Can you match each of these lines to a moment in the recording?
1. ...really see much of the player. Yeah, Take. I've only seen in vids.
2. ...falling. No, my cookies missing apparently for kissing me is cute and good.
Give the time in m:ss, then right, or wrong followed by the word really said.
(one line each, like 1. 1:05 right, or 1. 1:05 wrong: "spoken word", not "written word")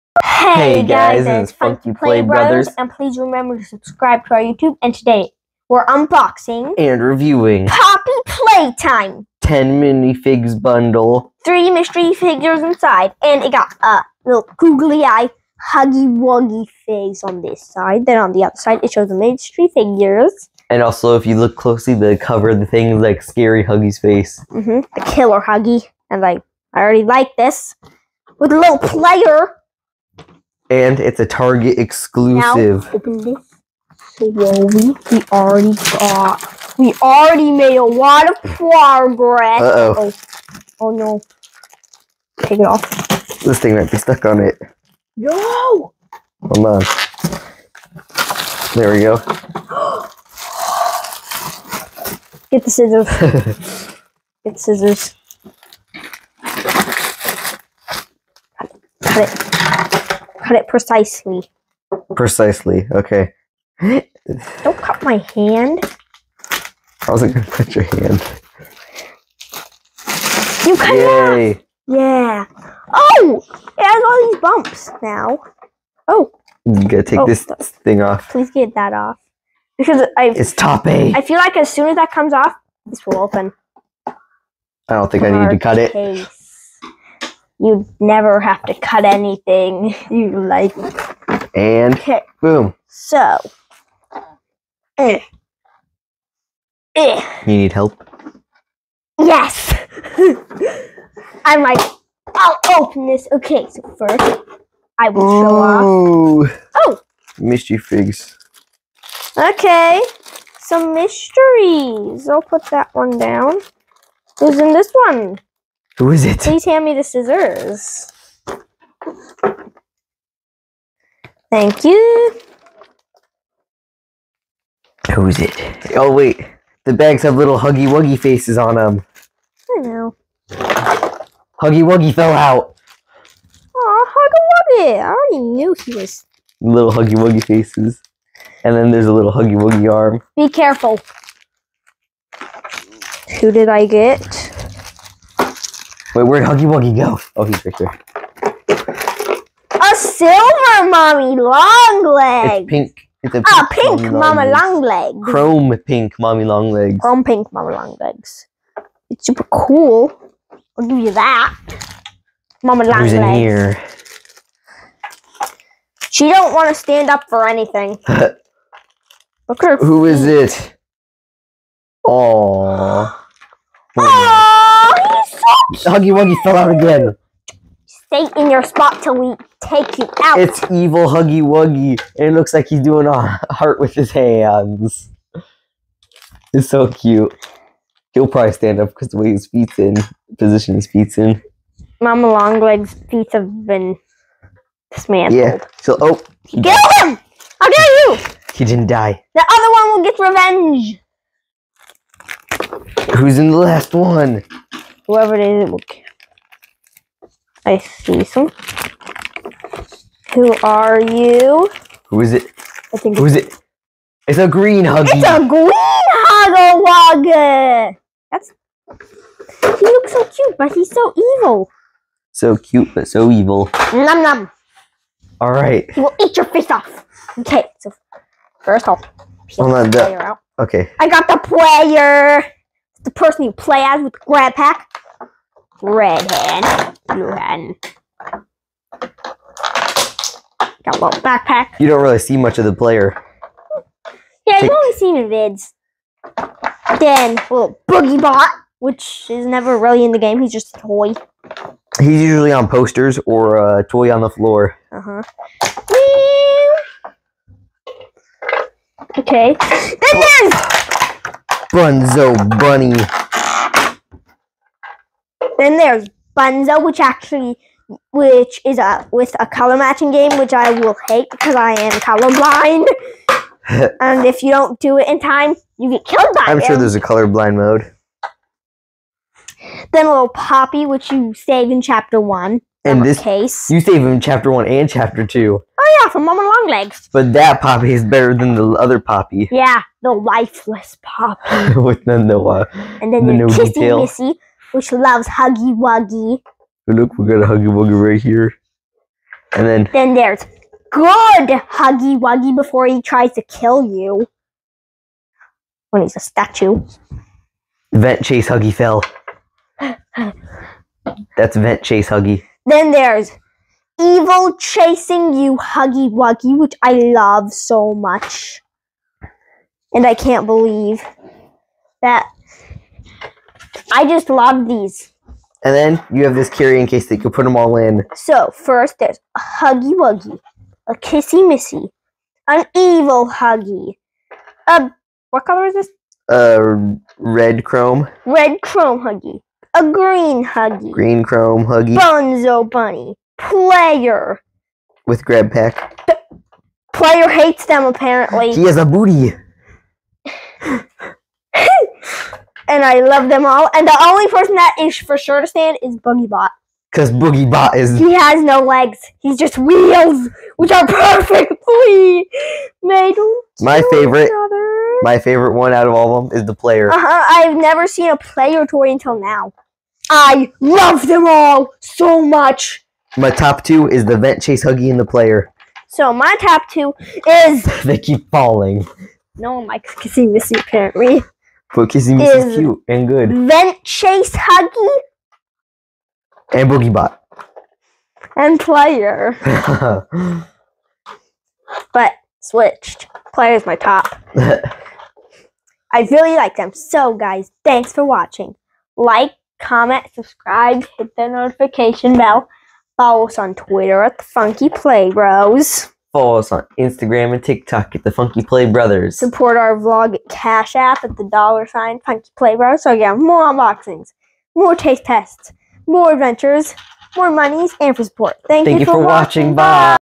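1. 4:02 right
2. 6:18 right.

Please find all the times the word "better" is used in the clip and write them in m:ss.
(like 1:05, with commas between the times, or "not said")
4:48.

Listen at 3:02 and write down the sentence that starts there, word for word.
It looks like he's doing a heart with his hands.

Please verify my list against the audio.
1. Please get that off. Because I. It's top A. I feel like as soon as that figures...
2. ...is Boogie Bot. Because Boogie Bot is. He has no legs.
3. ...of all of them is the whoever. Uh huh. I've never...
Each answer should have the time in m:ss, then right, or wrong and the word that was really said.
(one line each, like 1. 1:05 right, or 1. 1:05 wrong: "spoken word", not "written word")
1. 1:18 wrong: "comes", not "figures"
2. 5:55 right
3. 6:05 wrong: "player", not "whoever".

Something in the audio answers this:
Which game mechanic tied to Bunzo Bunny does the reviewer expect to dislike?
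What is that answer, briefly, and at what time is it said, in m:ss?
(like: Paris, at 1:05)
Color matching game, at 4:29.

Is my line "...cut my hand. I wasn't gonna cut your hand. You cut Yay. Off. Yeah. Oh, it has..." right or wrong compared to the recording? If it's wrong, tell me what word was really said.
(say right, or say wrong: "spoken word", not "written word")
right.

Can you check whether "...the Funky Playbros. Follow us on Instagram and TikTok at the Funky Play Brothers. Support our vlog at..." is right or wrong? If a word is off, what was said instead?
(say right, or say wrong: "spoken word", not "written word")
right.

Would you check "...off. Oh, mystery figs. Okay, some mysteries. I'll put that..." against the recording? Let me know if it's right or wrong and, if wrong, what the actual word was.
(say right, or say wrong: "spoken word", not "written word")
right.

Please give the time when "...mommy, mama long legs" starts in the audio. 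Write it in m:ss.
2:34.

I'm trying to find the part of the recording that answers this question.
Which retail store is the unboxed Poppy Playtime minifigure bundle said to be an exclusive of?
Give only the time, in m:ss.
0:31.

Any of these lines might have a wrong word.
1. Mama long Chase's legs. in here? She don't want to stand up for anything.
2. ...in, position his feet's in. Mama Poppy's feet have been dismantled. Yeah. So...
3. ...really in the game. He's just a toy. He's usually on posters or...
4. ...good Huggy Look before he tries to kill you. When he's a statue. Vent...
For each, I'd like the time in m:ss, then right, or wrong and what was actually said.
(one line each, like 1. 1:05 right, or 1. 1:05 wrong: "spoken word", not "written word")
1. 2:42 wrong: "Who", not "Chase"
2. 3:09 wrong: "Longleg", not "Poppy"
3. 4:09 right
4. 5:00 wrong: "Wuggy", not "Look".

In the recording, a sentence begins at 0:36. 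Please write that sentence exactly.
We already made a lot of progress.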